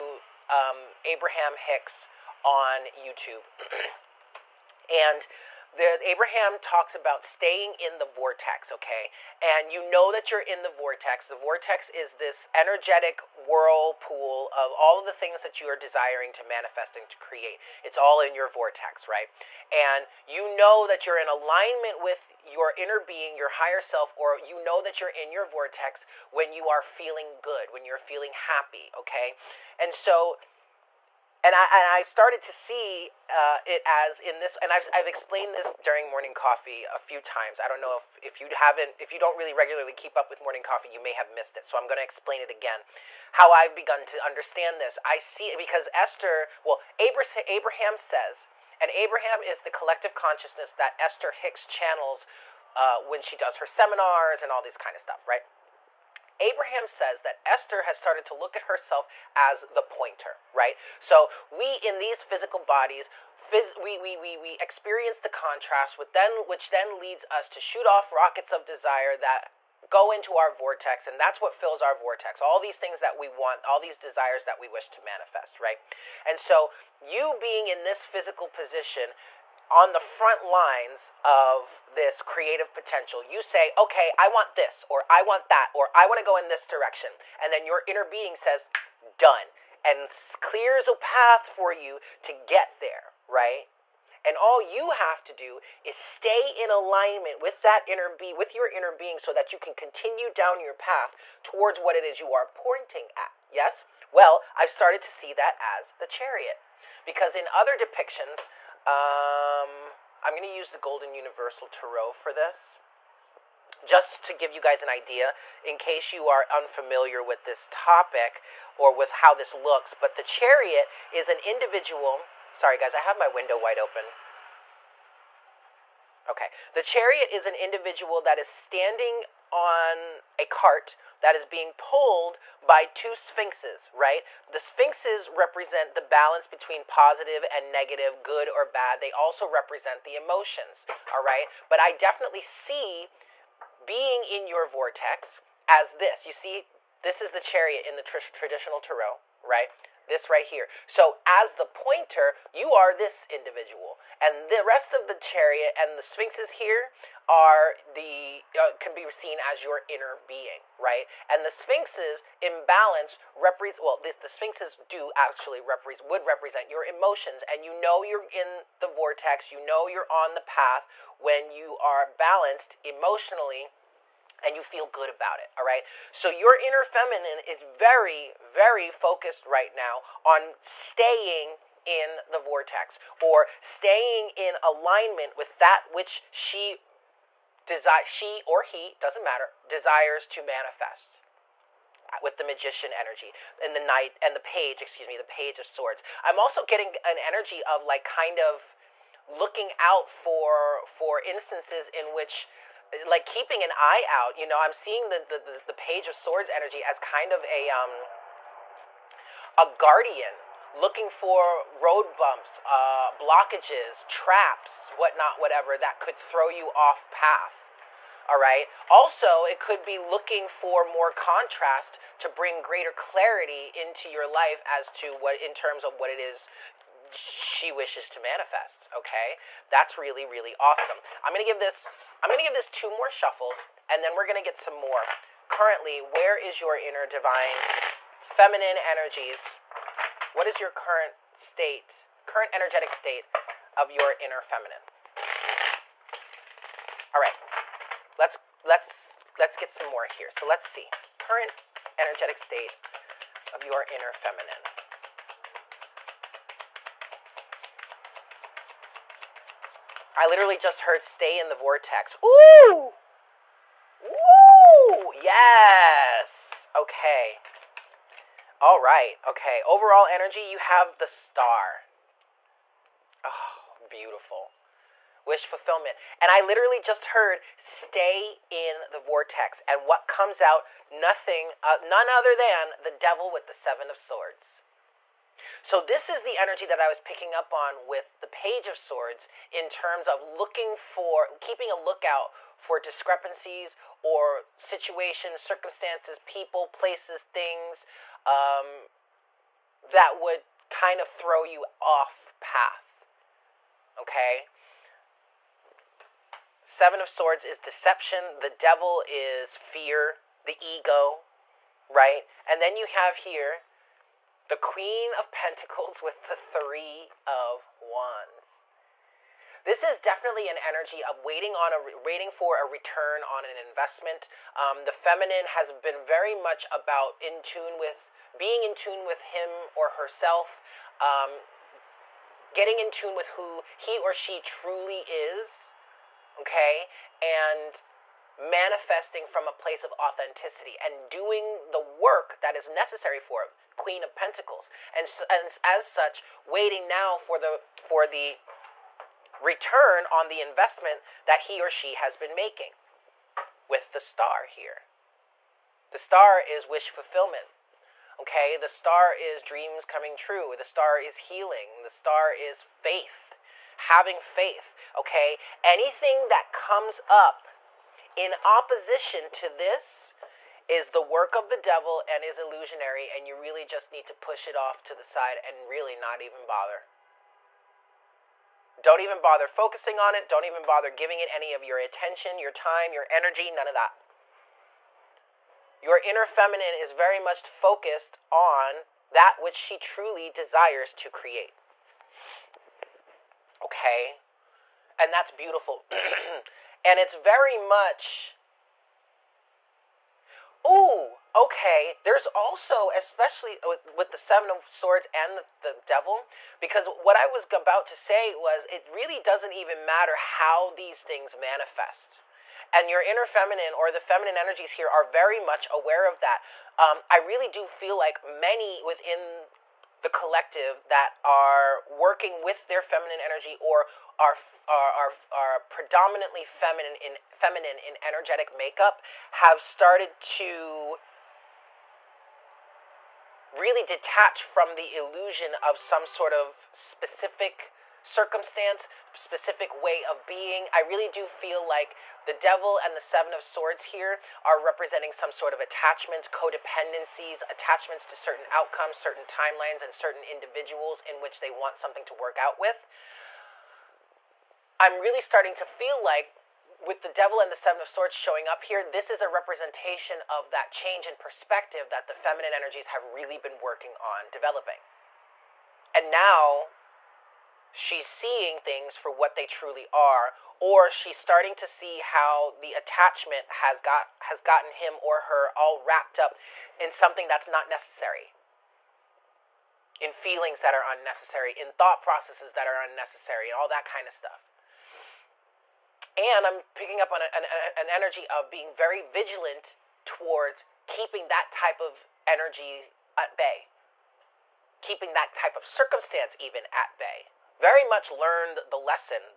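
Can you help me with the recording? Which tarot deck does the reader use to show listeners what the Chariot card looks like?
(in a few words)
Golden Universal Tarot.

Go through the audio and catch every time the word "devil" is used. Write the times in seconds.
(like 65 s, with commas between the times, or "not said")
282 s, 308 s, 371 s, 405 s, 442 s, 457 s.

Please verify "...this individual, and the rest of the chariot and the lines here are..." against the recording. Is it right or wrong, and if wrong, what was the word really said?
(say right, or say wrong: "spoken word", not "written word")
wrong: "sphinxes", not "lines".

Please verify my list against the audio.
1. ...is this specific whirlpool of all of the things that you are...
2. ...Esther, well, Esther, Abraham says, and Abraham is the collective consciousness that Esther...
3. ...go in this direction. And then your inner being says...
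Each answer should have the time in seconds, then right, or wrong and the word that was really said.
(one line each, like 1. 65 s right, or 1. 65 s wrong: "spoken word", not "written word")
1. 11 s wrong: "energetic", not "specific"
2. 45 s wrong: "Abraham", not "Esther"
3. 86 s right.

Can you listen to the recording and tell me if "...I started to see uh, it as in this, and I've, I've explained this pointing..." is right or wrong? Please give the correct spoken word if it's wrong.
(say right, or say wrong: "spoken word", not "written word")
wrong: "during", not "pointing".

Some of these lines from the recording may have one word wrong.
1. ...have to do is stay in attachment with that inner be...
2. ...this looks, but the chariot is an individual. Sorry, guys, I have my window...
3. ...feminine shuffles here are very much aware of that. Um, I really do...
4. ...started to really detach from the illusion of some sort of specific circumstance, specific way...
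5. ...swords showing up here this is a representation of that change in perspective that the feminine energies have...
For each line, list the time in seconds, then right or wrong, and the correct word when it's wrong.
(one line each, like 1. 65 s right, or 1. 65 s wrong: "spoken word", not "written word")
1. 94 s wrong: "alignment", not "attachment"
2. 119 s right
3. 413 s wrong: "energies", not "shuffles"
4. 429 s right
5. 457 s right.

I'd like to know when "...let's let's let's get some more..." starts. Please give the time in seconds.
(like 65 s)
248 s.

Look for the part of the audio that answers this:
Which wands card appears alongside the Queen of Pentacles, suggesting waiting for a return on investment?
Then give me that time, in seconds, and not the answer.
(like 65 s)
316 s.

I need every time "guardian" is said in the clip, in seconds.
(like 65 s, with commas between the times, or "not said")
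209 s.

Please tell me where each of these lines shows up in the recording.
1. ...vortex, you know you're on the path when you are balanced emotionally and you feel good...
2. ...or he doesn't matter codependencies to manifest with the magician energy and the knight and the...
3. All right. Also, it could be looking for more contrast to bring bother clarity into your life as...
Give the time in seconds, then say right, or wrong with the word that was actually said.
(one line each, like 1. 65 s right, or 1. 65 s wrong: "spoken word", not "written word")
1. 168 s right
2. 188 s wrong: "desires", not "codependencies"
3. 218 s wrong: "greater", not "bother".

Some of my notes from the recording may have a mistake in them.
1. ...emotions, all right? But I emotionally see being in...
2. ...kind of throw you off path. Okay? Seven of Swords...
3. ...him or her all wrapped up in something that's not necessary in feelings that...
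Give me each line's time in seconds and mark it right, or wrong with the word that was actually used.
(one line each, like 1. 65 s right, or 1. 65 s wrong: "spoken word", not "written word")
1. 140 s wrong: "definitely", not "emotionally"
2. 300 s right
3. 474 s right.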